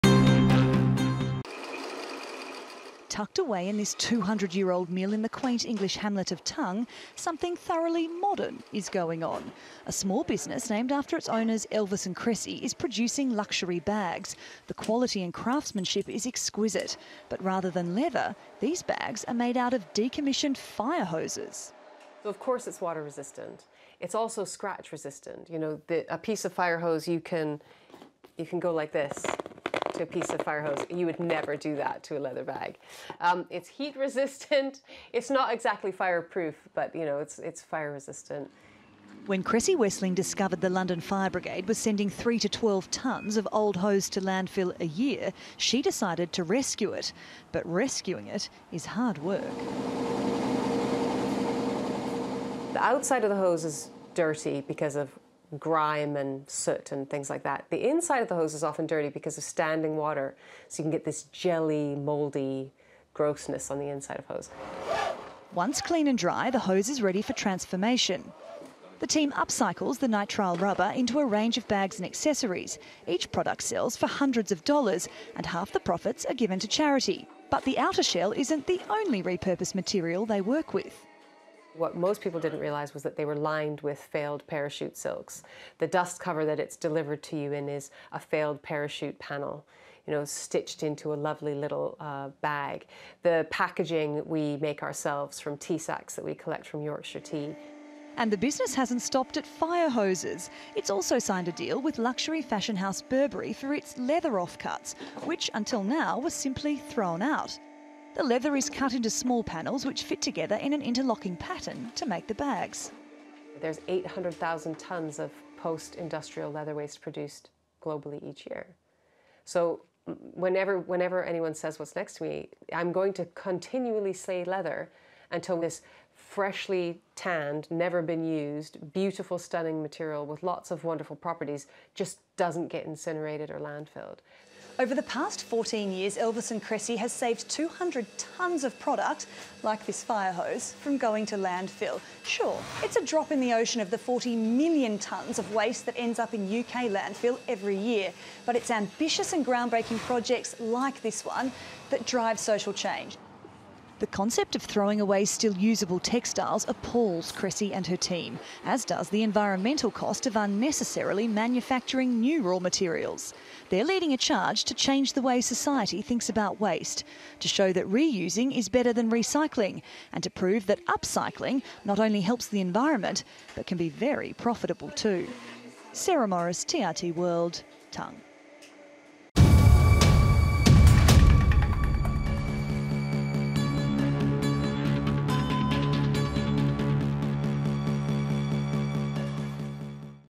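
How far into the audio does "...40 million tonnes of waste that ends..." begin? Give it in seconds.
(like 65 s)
143 s.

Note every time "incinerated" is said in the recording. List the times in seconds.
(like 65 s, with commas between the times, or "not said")
132 s.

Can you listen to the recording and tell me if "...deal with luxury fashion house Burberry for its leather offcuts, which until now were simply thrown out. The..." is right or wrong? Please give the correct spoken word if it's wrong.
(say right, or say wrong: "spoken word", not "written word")
right.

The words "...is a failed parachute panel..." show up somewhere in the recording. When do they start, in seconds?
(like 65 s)
87 s.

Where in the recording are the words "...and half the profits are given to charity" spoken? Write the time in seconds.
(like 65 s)
75 s.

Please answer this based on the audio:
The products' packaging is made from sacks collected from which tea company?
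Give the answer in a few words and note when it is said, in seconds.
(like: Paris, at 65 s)
Yorkshire Tea, at 96 s.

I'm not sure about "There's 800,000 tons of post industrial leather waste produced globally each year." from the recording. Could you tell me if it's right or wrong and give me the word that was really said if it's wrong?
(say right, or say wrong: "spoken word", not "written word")
right.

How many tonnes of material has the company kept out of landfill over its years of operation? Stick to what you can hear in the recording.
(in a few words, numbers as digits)
200 tonnes.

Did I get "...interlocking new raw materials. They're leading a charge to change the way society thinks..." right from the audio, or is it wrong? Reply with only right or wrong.
wrong.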